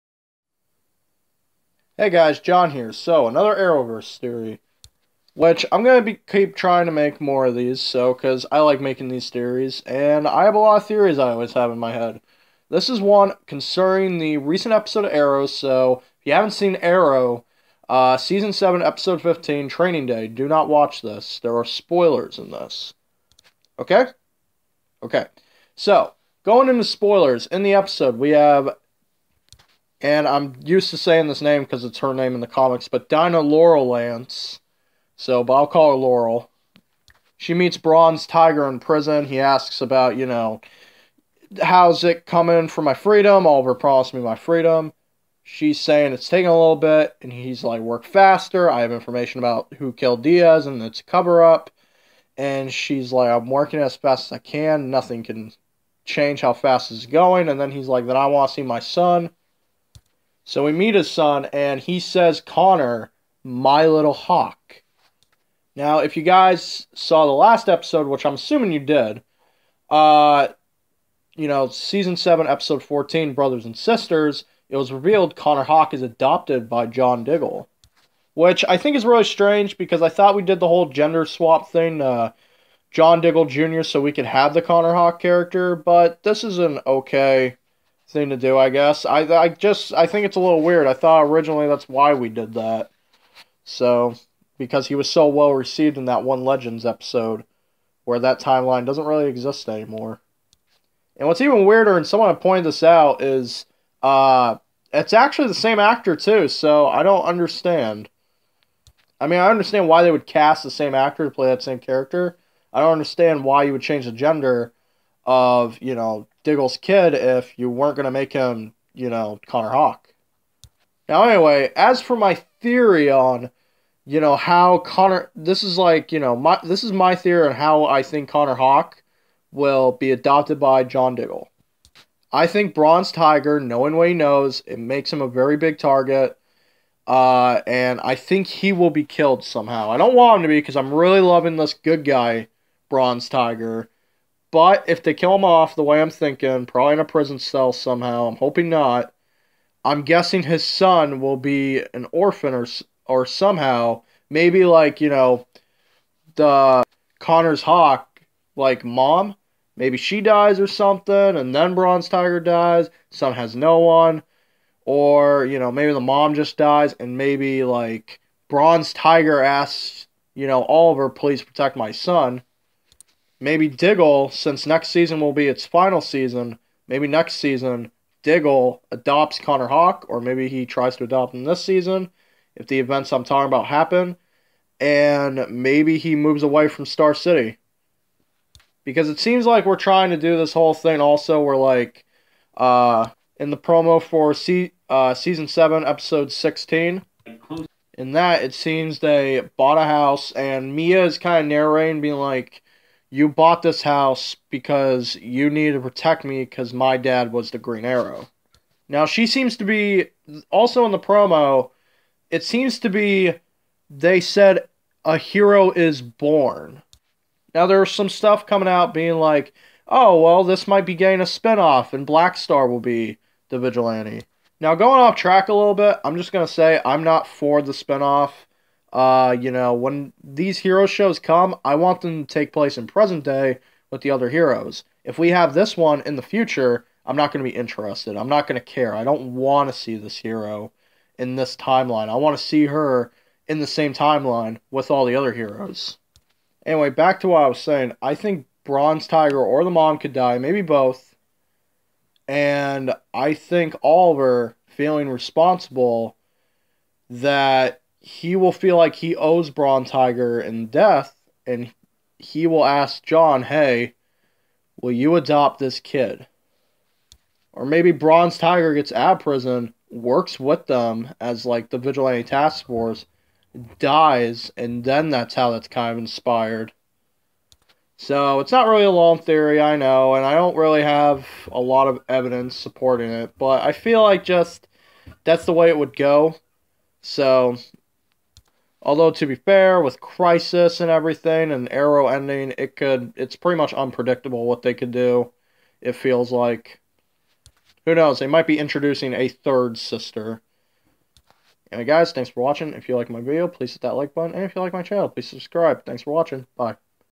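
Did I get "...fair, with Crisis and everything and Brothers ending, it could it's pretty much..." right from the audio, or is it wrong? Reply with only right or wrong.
wrong.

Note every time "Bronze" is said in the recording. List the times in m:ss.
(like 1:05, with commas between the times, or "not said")
0:37, 2:12, 2:22, 2:41, 2:48, 4:08, 4:19, 4:27.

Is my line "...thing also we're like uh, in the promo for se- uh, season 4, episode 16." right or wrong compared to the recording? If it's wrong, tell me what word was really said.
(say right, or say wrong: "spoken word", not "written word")
wrong: "7", not "4".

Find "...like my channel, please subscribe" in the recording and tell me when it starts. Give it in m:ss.
5:04.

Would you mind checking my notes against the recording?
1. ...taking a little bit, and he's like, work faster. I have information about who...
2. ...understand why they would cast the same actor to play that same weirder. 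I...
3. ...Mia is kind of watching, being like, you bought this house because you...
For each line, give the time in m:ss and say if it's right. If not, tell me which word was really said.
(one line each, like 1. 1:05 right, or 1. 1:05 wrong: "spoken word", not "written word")
1. 0:46 right
2. 1:49 wrong: "character", not "weirder"
3. 3:20 wrong: "narrating", not "watching".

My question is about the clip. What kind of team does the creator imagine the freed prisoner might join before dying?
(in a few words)
vigilante task force.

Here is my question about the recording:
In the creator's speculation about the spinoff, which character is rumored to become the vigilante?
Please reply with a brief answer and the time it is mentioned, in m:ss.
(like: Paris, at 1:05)
Black Star, at 3:42.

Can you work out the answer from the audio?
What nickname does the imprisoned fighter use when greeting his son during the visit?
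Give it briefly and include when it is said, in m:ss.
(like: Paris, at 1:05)
my little hawk, at 1:03.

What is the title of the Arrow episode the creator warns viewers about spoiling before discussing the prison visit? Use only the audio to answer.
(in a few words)
Training Day.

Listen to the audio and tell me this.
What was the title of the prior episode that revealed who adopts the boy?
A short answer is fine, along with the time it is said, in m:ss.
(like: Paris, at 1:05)
Brothers and Sisters, at 1:13.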